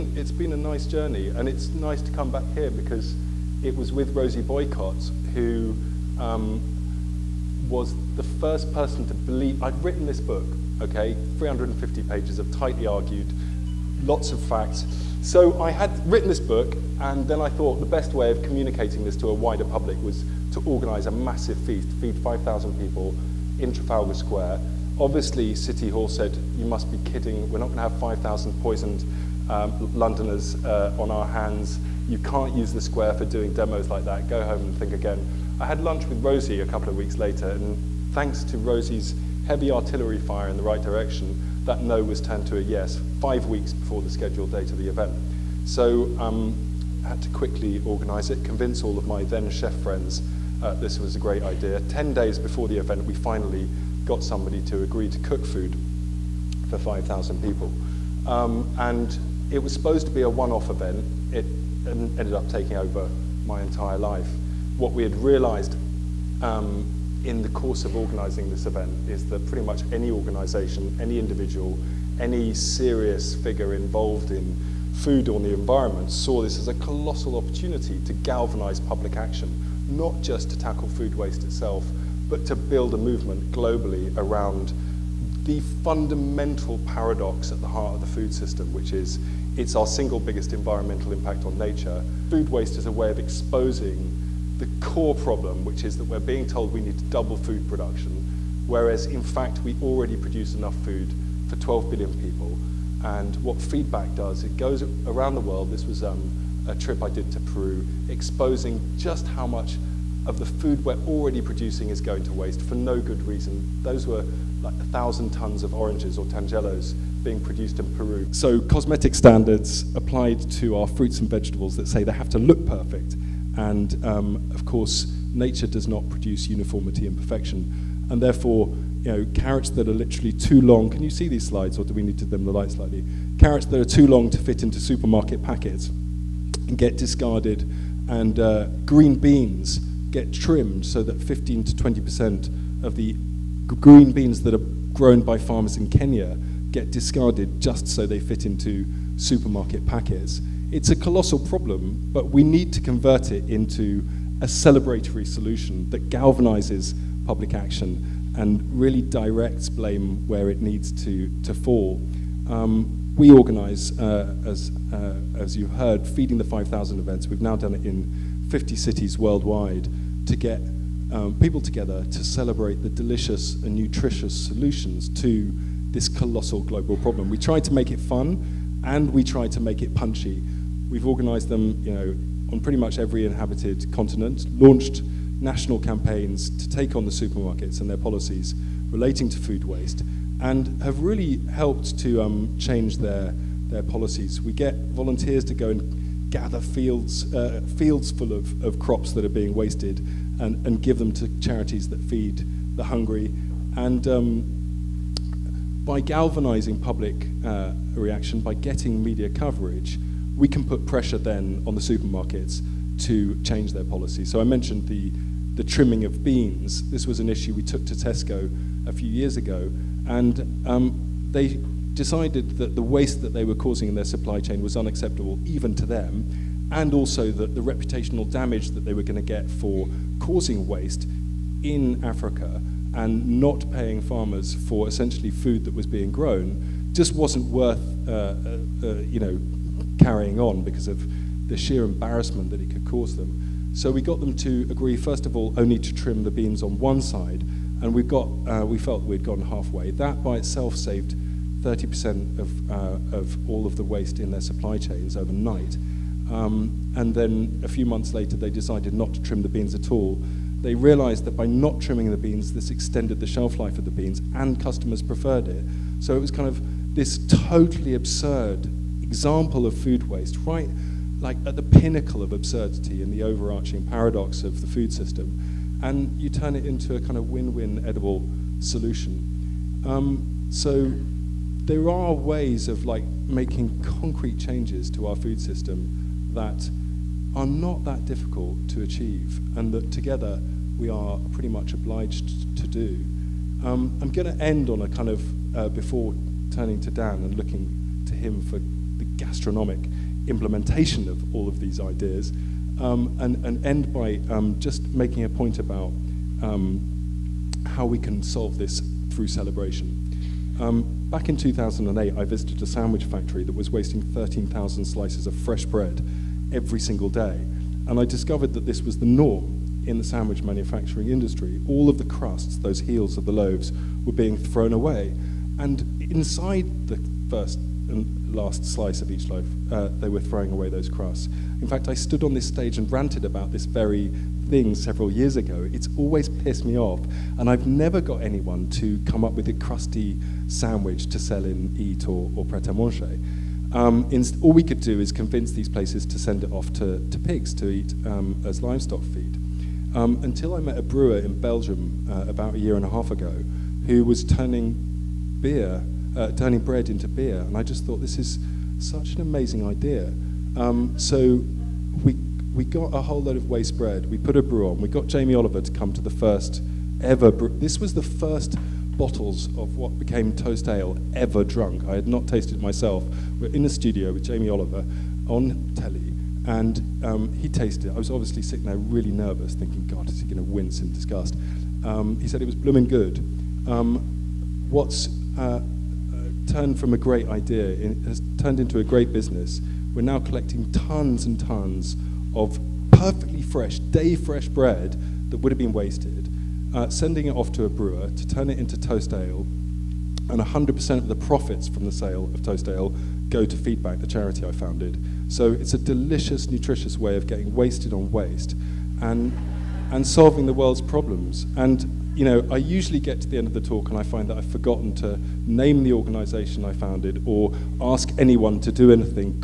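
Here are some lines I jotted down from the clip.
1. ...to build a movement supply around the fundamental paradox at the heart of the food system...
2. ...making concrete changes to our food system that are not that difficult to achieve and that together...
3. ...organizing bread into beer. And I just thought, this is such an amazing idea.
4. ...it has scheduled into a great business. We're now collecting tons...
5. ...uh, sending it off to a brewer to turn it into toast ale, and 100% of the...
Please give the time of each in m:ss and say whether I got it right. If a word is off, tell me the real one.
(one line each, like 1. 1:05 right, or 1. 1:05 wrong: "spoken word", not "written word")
1. 1:22 wrong: "globally", not "supply"
2. 4:43 right
3. 5:56 wrong: "turning", not "organizing"
4. 6:27 wrong: "turned", not "scheduled"
5. 6:36 right.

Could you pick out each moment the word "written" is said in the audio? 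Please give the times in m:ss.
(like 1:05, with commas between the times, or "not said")
0:09, 0:16.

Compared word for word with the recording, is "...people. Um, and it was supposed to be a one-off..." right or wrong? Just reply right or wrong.
right.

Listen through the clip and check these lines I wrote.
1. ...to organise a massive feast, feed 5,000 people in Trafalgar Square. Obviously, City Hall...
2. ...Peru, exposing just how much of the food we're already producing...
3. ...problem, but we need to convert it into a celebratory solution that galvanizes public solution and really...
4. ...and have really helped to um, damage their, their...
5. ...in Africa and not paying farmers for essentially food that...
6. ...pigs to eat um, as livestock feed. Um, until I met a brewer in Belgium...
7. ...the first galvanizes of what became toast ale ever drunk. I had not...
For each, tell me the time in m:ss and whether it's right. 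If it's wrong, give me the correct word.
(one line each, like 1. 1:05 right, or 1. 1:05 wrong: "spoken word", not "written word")
1. 0:20 right
2. 1:47 right
3. 2:31 wrong: "action", not "solution"
4. 3:10 wrong: "change", not "damage"
5. 3:51 right
6. 5:47 right
7. 6:07 wrong: "bottles", not "galvanizes".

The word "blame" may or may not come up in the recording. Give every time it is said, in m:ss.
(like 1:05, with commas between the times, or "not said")
2:39.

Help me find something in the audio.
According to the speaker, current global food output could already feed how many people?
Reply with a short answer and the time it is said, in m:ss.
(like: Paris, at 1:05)
12 billion, at 1:41.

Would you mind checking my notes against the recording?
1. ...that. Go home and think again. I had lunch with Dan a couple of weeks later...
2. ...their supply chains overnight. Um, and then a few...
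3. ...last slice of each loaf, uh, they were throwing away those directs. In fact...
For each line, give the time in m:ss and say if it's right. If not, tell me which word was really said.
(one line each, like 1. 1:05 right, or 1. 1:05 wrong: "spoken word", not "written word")
1. 0:34 wrong: "Rosie", not "Dan"
2. 4:14 right
3. 5:28 wrong: "crusts", not "directs".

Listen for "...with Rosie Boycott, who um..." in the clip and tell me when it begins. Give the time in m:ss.
0:03.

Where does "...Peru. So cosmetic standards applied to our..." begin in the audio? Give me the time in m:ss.
1:57.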